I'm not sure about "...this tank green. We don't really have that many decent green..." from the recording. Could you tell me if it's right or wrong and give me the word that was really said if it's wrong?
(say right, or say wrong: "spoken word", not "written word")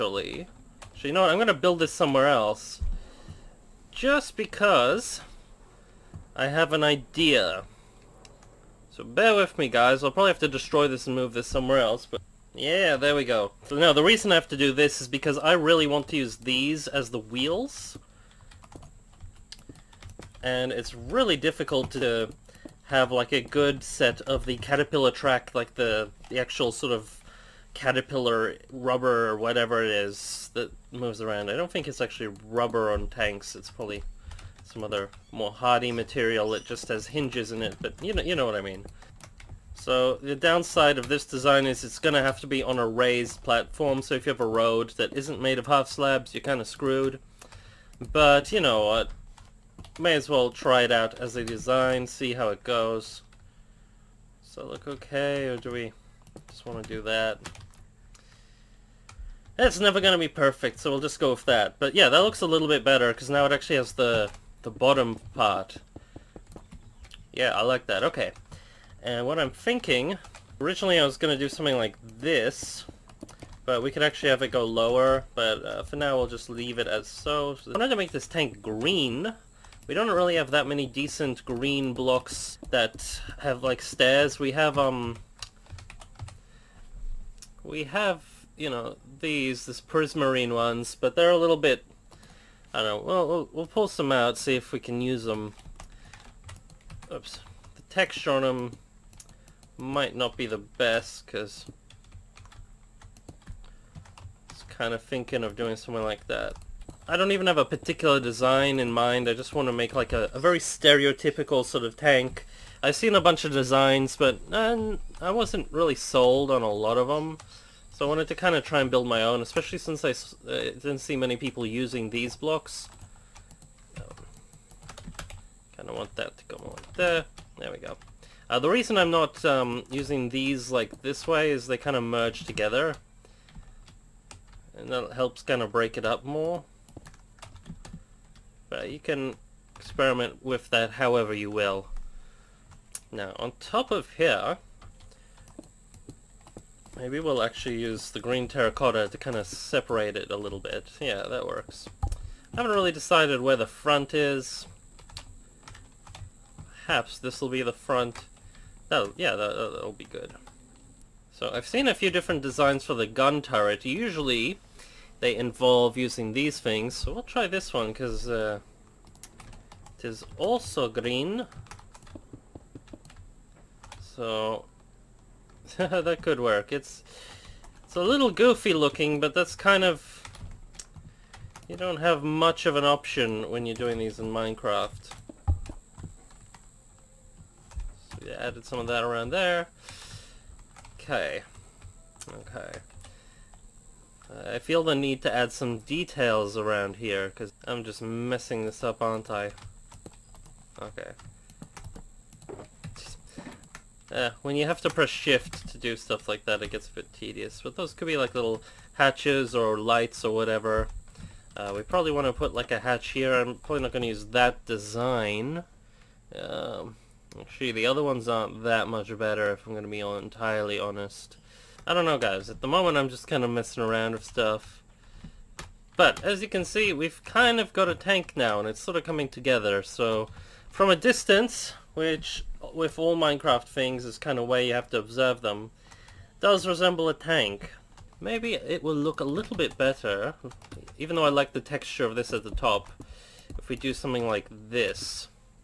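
right.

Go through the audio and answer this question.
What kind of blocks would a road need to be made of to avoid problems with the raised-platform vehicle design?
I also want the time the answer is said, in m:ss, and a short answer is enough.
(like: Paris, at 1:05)
half slabs, at 0:45.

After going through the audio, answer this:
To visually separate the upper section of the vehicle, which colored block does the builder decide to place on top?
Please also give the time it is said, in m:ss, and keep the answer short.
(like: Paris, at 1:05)
green terracotta, at 2:28.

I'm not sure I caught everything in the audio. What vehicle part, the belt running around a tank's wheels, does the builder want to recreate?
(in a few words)
caterpillar track.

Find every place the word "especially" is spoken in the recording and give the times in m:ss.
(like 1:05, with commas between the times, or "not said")
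1:59.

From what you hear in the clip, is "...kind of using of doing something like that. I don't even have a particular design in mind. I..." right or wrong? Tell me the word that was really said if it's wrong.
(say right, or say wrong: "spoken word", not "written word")
wrong: "thinking", not "using".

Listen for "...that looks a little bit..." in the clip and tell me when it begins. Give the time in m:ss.
1:02.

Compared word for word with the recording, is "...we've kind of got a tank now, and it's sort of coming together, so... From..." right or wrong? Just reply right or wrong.
right.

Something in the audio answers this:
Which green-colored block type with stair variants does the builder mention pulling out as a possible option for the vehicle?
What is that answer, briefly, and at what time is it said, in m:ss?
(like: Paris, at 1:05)
prismarine, at 1:29.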